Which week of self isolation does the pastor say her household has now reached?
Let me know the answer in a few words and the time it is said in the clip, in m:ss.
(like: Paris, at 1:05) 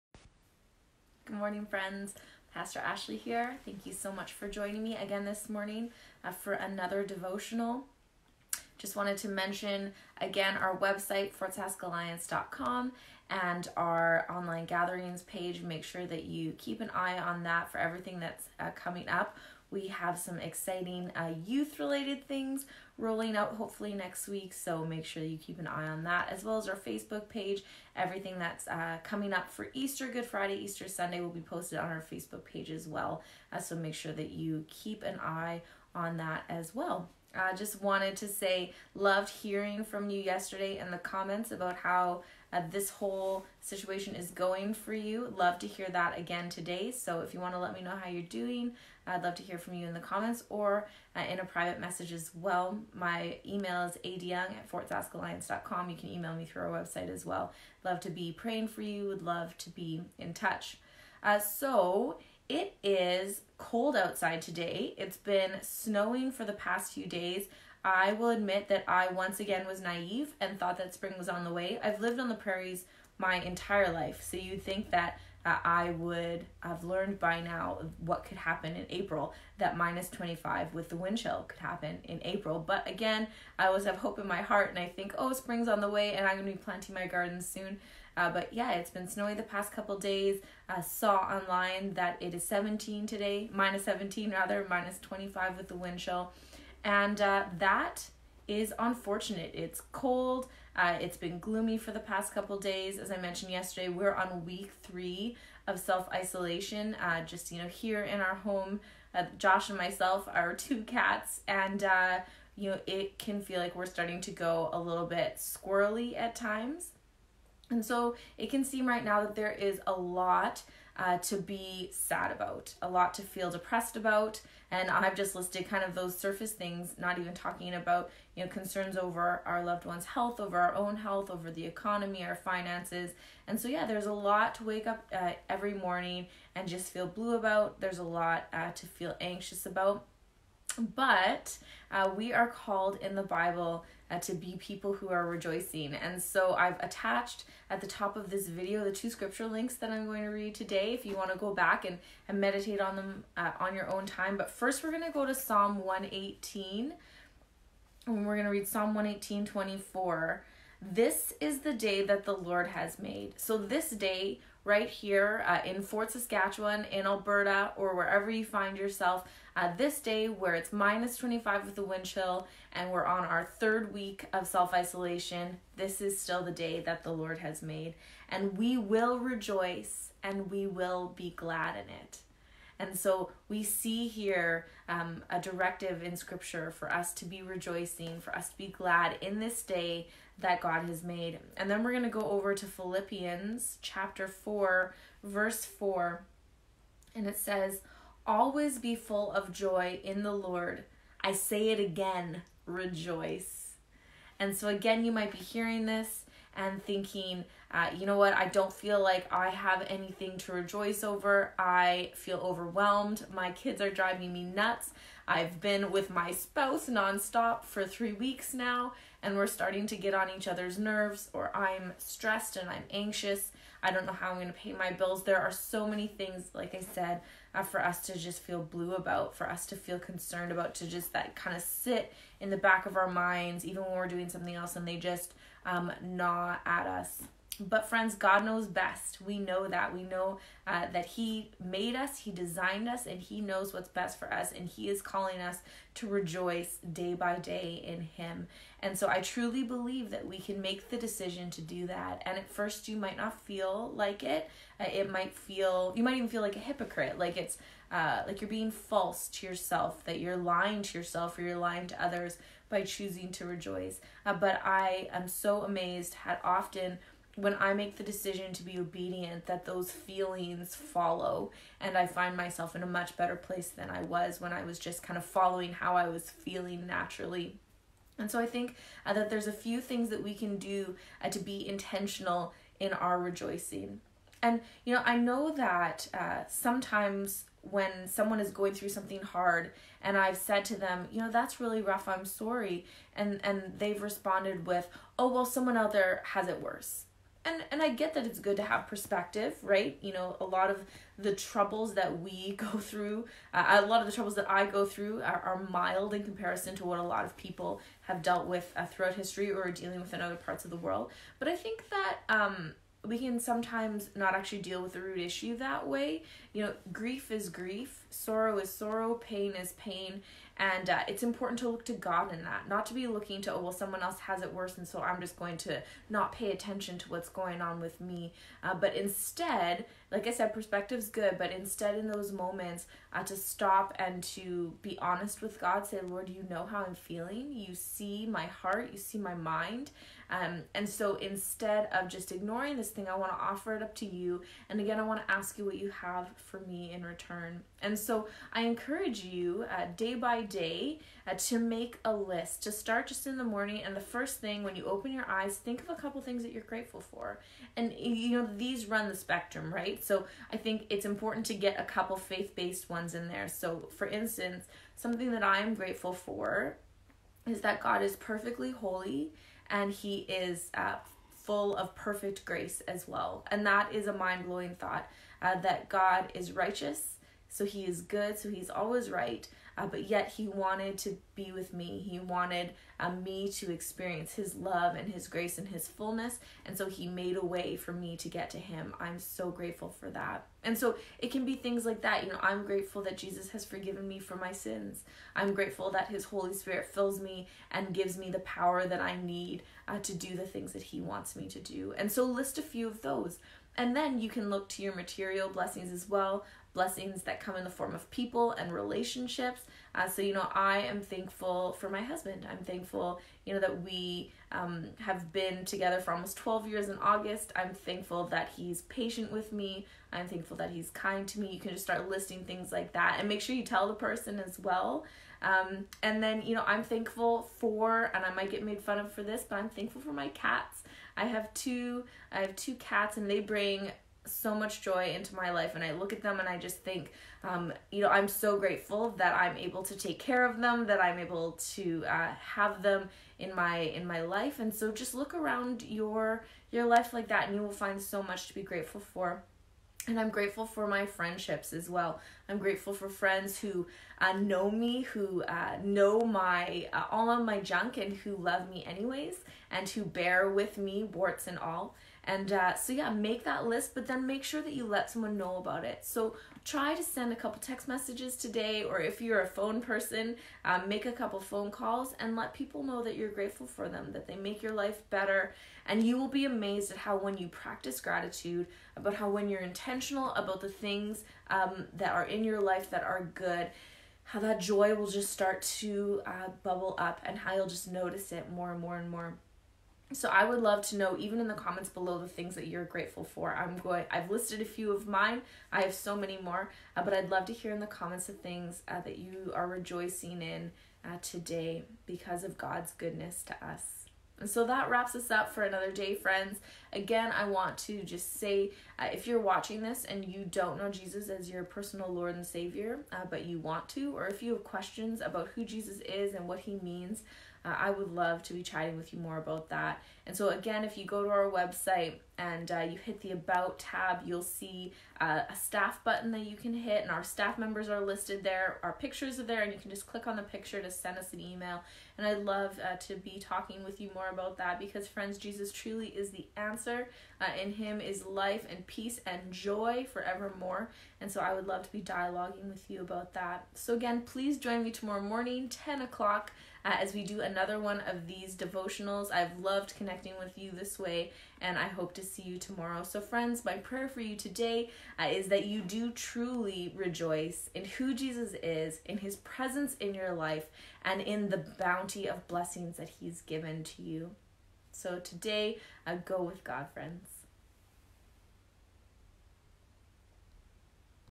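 Week 3, at 1:44.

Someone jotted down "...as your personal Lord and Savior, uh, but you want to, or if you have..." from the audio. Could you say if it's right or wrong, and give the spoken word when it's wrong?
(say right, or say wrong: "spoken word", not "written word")
right.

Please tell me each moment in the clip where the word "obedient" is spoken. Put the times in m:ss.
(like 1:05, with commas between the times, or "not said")
4:28.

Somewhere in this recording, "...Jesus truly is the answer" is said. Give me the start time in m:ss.
8:55.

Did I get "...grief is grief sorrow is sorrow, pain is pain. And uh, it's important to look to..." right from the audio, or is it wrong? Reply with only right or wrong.
right.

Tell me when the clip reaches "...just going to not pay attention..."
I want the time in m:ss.
5:25.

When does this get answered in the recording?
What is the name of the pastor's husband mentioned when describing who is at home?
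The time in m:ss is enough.
1:49.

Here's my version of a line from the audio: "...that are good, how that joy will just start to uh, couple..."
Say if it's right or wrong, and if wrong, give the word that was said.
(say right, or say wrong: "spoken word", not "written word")
wrong: "bubble", not "couple".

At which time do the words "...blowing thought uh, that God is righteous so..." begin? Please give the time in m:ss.
6:14.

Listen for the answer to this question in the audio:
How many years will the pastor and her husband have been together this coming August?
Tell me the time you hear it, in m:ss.
6:56.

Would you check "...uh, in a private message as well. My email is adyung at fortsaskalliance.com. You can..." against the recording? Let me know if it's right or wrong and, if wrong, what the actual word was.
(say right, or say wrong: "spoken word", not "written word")
right.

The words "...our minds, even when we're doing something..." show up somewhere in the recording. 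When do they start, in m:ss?
3:52.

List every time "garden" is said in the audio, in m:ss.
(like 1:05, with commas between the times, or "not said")
1:27.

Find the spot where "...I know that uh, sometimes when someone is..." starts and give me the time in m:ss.
4:45.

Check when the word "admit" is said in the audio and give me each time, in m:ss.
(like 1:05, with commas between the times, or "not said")
1:08.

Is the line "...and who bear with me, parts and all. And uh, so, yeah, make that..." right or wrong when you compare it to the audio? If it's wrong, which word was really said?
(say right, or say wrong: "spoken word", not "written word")
wrong: "warts", not "parts".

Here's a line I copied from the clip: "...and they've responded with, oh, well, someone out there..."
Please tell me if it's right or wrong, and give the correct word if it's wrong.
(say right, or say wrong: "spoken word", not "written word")
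right.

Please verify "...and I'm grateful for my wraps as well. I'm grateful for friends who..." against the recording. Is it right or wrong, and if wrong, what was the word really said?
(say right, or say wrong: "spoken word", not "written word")
wrong: "friendships", not "wraps".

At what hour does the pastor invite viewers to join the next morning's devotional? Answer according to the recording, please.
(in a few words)
10 o'clock.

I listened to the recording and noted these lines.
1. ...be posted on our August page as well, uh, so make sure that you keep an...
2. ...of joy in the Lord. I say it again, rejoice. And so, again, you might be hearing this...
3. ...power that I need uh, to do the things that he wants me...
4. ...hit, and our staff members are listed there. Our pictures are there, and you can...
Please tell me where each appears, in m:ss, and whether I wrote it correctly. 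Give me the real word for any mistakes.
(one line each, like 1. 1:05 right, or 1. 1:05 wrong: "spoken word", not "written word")
1. 0:31 wrong: "Facebook", not "August"
2. 3:19 right
3. 6:38 right
4. 8:46 right.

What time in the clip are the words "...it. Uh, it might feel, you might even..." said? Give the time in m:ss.
4:14.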